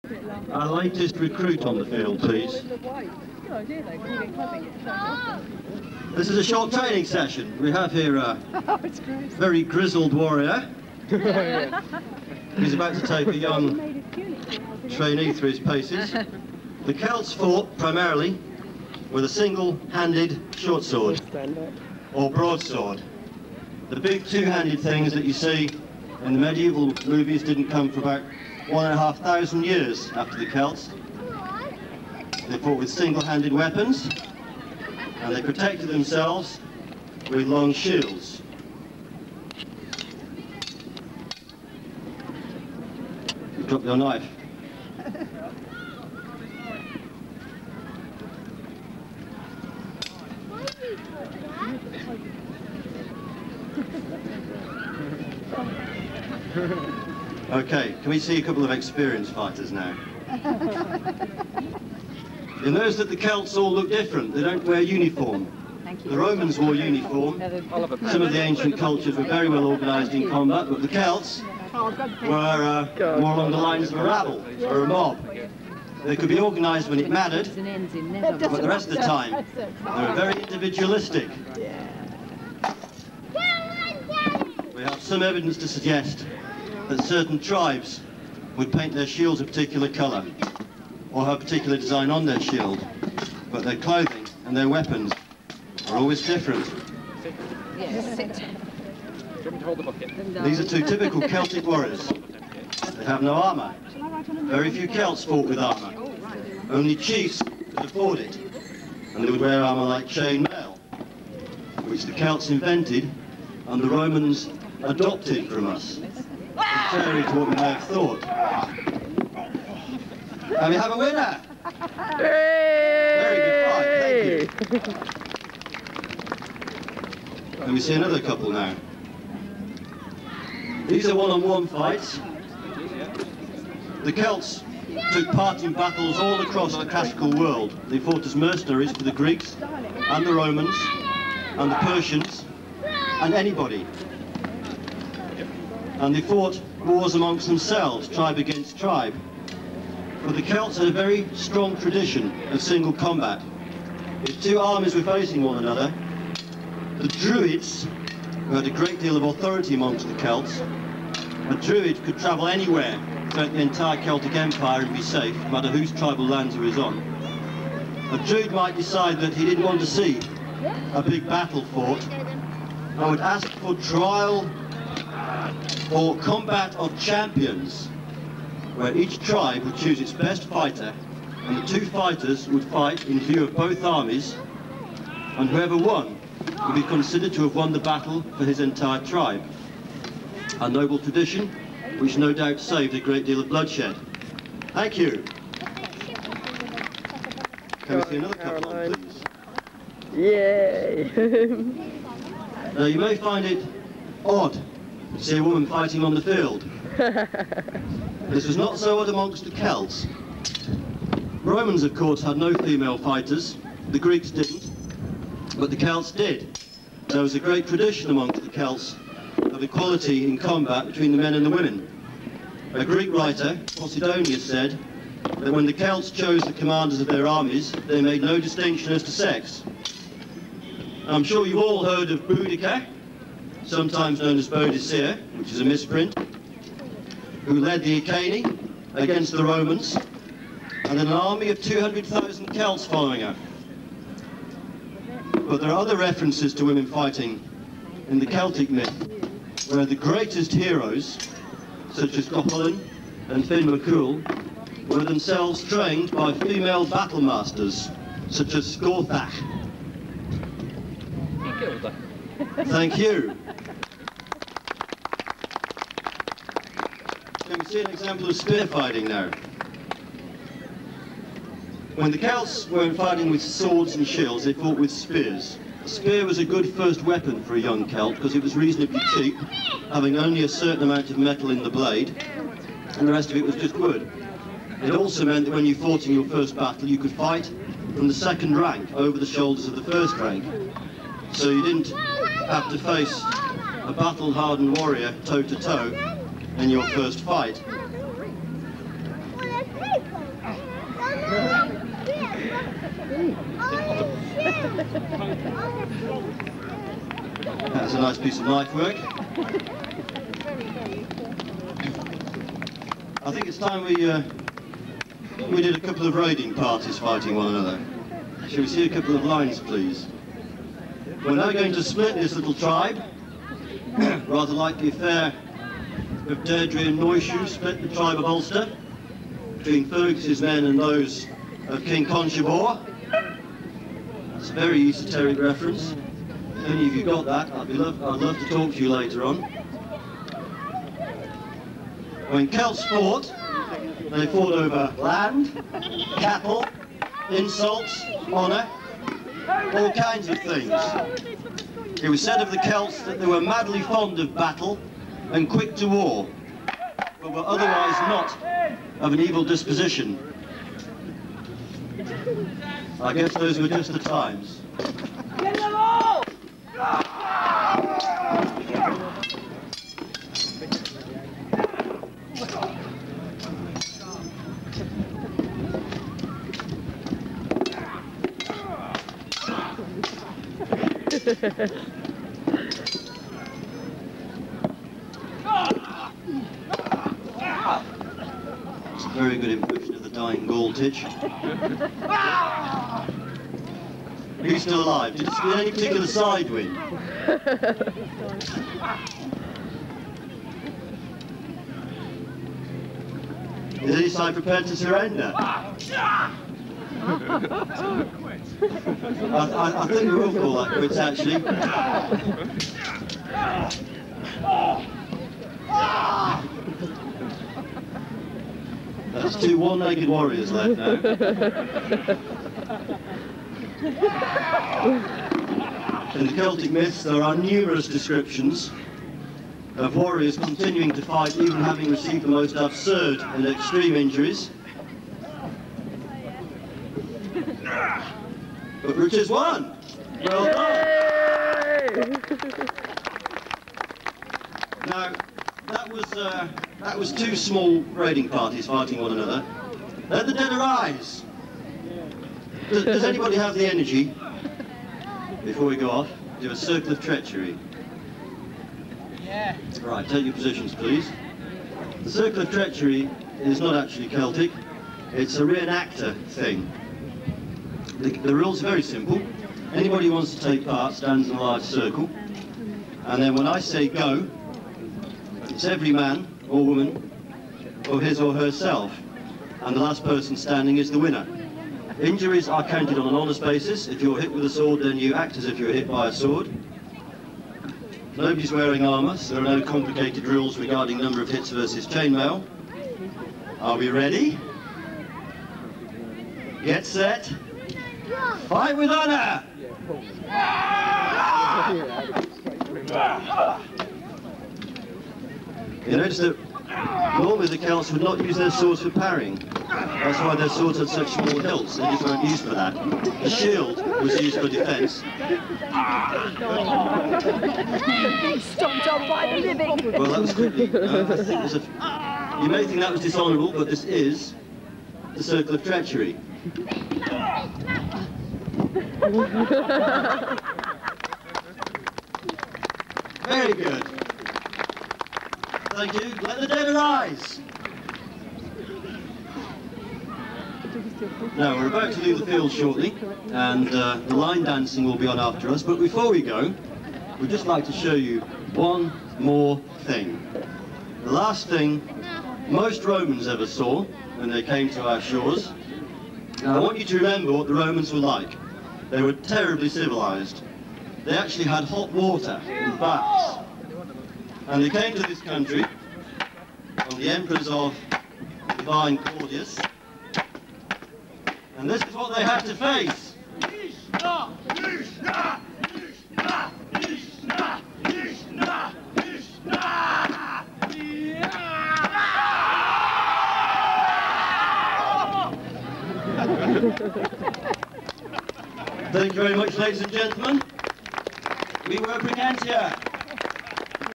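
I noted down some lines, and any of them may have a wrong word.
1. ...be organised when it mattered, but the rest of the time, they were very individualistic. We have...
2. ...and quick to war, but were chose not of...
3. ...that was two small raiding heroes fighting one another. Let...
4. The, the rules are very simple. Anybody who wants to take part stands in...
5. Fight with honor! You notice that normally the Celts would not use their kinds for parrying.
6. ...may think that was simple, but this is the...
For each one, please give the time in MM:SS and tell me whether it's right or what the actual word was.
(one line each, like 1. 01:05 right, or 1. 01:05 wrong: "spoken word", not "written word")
1. 01:16 right
2. 05:55 wrong: "otherwise", not "chose"
3. 07:26 wrong: "parties", not "heroes"
4. 07:48 right
5. 08:18 wrong: "swords", not "kinds"
6. 08:42 wrong: "dishonourable", not "simple".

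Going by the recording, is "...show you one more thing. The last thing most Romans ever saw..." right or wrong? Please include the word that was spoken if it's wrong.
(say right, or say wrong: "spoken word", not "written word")
right.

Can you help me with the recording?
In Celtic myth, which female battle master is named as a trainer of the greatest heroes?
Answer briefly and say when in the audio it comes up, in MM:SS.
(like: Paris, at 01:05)
Scathach, at 04:18.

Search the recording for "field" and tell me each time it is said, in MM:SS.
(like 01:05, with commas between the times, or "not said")
00:01, 03:26, 09:02.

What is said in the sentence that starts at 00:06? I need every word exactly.
This is a short training session.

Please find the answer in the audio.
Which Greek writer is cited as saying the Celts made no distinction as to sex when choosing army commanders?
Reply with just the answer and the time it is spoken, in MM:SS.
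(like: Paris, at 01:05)
Posidonius, at 03:43.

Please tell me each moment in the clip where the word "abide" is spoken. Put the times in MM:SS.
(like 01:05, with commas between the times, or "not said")
not said.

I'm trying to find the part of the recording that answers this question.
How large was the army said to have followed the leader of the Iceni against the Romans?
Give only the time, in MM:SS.
04:01.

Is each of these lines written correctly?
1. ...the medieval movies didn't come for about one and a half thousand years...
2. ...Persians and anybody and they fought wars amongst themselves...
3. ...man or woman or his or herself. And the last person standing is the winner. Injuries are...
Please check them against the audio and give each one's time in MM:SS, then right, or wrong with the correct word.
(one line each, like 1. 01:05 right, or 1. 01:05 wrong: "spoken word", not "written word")
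1. 00:26 right
2. 02:21 right
3. 07:55 right.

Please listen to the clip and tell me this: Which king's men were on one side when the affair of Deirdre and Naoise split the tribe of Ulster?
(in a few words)
King Conchobar.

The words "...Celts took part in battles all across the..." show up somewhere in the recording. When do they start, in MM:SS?
02:14.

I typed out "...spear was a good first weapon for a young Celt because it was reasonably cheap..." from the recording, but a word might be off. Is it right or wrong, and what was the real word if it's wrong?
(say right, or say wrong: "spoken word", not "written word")
right.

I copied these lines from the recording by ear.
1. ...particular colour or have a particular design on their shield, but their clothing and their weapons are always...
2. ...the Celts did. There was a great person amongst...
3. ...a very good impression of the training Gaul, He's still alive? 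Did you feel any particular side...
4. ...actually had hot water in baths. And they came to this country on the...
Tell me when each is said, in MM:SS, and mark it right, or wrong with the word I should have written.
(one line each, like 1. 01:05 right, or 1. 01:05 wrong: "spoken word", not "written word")
1. 01:29 right
2. 03:35 wrong: "tradition", not "person"
3. 06:29 wrong: "dying", not "training"
4. 09:21 right.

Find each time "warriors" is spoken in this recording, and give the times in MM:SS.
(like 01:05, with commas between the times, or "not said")
00:10, 01:41, 04:54, 07:00, 07:09.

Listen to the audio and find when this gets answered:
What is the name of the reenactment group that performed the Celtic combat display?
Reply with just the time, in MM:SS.
09:52.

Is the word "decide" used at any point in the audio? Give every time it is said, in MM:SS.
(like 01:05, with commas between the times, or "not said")
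02:48.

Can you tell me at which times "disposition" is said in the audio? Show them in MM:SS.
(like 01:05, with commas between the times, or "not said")
05:59.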